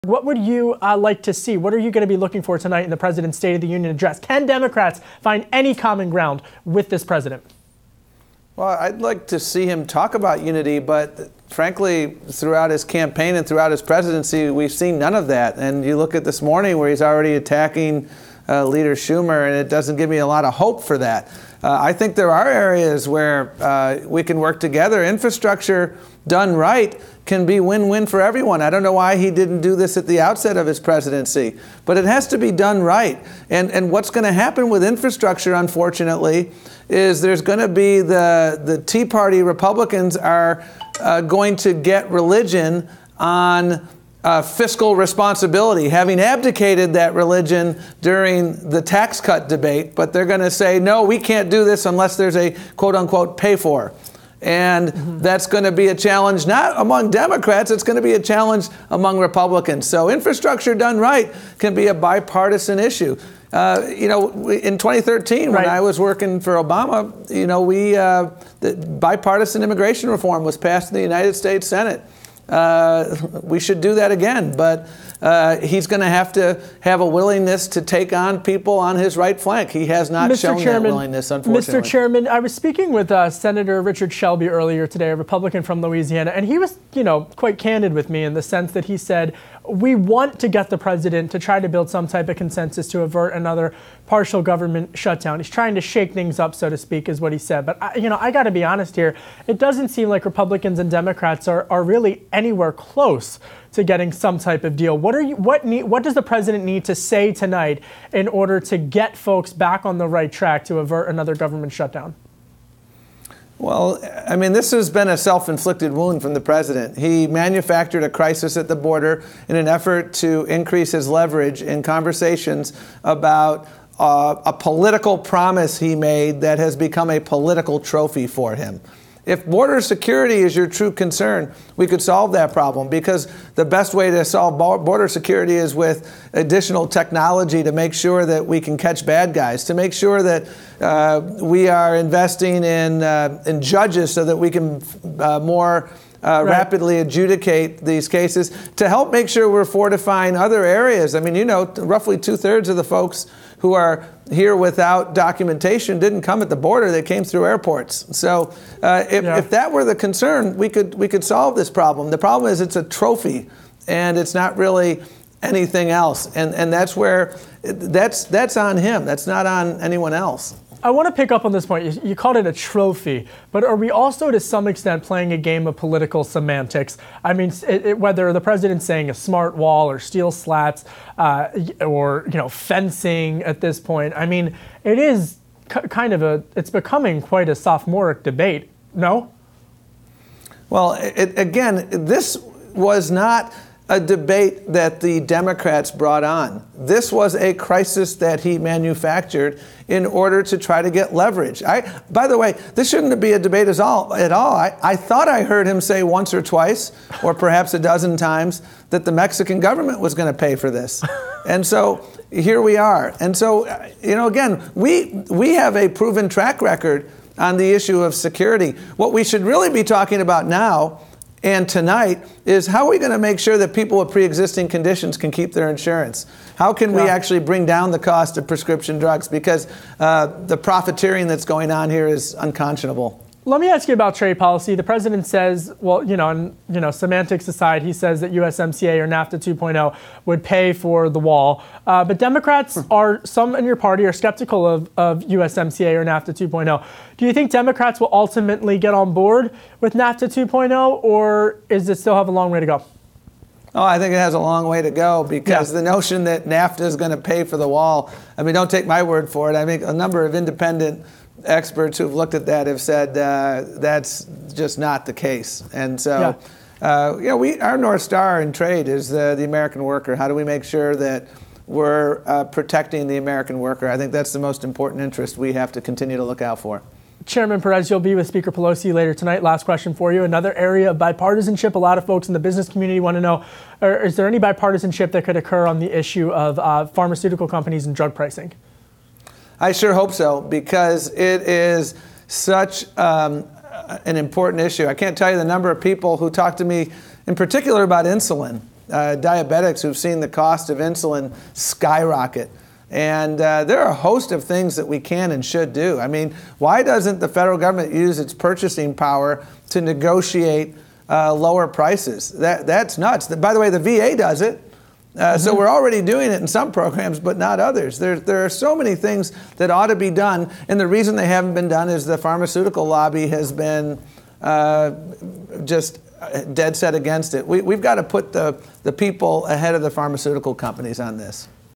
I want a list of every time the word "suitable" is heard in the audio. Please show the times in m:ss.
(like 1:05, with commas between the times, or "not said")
not said.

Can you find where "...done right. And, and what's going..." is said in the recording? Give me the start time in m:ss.
0:32.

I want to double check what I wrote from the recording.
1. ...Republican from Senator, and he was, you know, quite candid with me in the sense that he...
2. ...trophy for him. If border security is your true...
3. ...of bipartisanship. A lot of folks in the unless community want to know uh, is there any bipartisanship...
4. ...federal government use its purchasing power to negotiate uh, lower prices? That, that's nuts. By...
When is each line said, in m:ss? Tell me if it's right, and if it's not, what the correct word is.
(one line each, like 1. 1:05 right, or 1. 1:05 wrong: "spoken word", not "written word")
1. 1:25 wrong: "Louisiana", not "Senator"
2. 2:07 right
3. 4:40 wrong: "business", not "unless"
4. 5:07 right.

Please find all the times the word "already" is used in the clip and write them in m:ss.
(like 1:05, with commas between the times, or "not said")
0:17, 5:15.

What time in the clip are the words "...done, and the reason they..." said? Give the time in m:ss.
5:20.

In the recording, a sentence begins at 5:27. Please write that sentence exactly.
We, we've got to put the, the people ahead of the pharmaceutical companies on this.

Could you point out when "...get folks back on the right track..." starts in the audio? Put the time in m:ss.
1:48.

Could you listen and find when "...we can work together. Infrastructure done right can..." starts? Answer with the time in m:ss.
0:24.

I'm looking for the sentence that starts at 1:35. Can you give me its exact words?
He's trying to shake things up, so to speak, is what he said.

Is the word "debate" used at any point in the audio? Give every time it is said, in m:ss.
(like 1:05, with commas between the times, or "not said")
0:49, 3:08, 3:13, 3:23.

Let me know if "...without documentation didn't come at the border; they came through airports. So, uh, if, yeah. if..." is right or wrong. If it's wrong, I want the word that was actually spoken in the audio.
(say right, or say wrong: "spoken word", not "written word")
right.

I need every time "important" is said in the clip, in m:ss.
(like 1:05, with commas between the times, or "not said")
4:34, 4:54.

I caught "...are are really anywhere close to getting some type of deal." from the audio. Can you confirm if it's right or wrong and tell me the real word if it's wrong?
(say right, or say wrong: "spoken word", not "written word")
right.